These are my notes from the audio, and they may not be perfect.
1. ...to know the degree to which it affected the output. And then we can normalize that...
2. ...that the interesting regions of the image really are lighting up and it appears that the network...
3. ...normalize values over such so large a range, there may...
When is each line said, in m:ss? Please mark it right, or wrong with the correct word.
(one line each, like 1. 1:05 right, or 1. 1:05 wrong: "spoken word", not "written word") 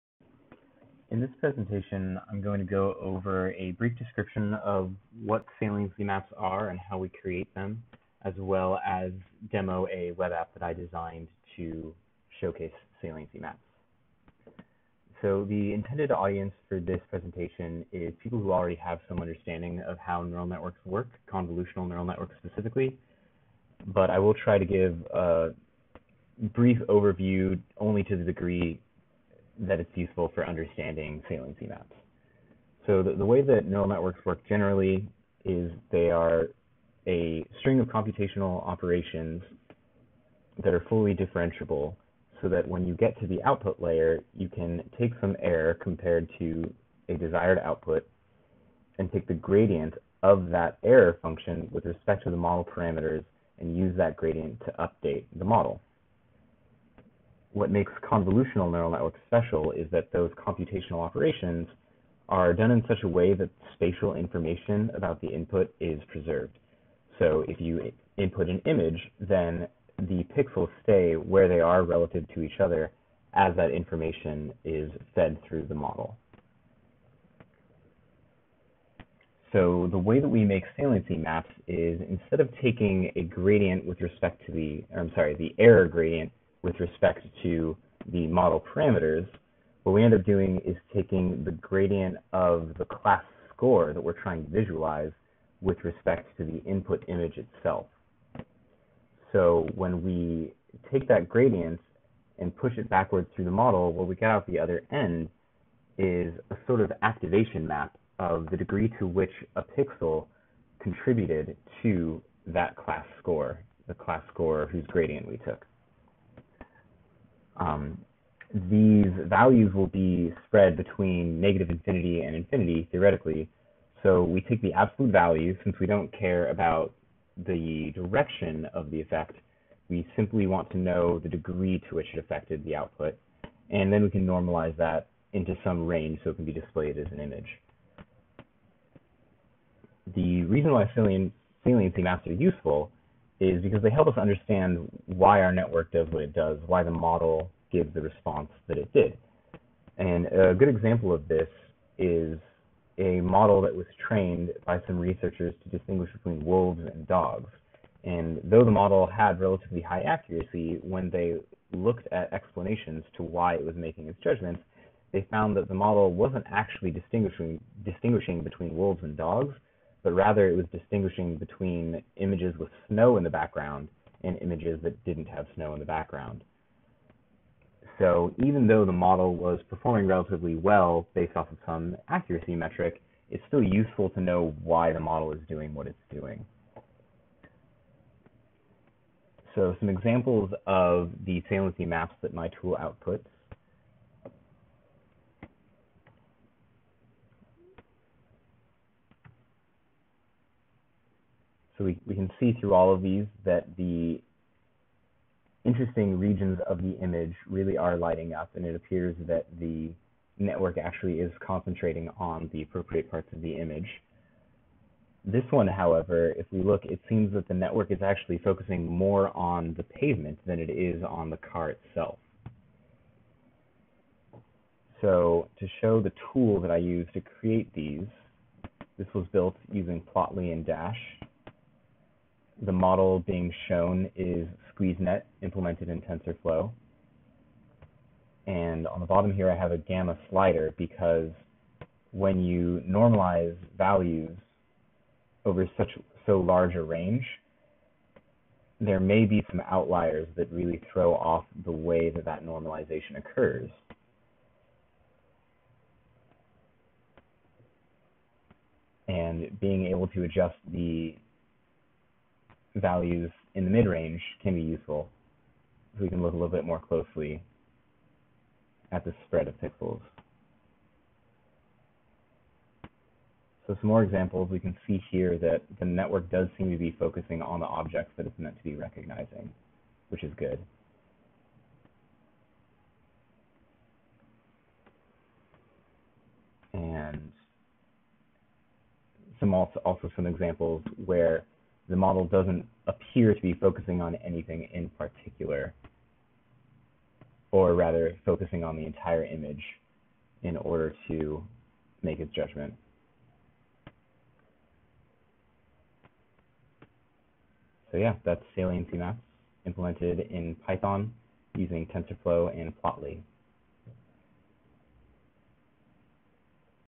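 1. 2:10 right
2. 3:23 right
3. 4:02 right.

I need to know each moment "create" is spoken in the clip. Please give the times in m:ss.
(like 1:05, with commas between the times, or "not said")
0:07, 3:47.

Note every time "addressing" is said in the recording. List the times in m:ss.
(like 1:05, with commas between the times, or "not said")
not said.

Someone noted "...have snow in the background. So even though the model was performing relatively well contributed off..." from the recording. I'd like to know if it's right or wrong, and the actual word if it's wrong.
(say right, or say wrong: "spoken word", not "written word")
wrong: "based", not "contributed".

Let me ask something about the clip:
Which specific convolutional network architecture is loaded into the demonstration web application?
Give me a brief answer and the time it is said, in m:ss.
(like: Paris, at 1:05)
SqueezeNet, at 3:54.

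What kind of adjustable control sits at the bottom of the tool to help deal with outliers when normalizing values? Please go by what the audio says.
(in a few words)
gamma slider.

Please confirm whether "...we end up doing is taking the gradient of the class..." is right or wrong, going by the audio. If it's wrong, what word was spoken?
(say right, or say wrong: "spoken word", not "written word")
right.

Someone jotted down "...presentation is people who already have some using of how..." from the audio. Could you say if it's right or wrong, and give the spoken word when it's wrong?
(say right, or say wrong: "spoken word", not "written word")
wrong: "understanding", not "using".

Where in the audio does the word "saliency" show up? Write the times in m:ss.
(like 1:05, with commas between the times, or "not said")
0:05, 0:13, 0:31, 1:20, 2:20, 3:11, 5:08.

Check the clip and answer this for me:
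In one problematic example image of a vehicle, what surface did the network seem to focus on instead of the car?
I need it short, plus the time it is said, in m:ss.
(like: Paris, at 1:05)
the pavement, at 3:39.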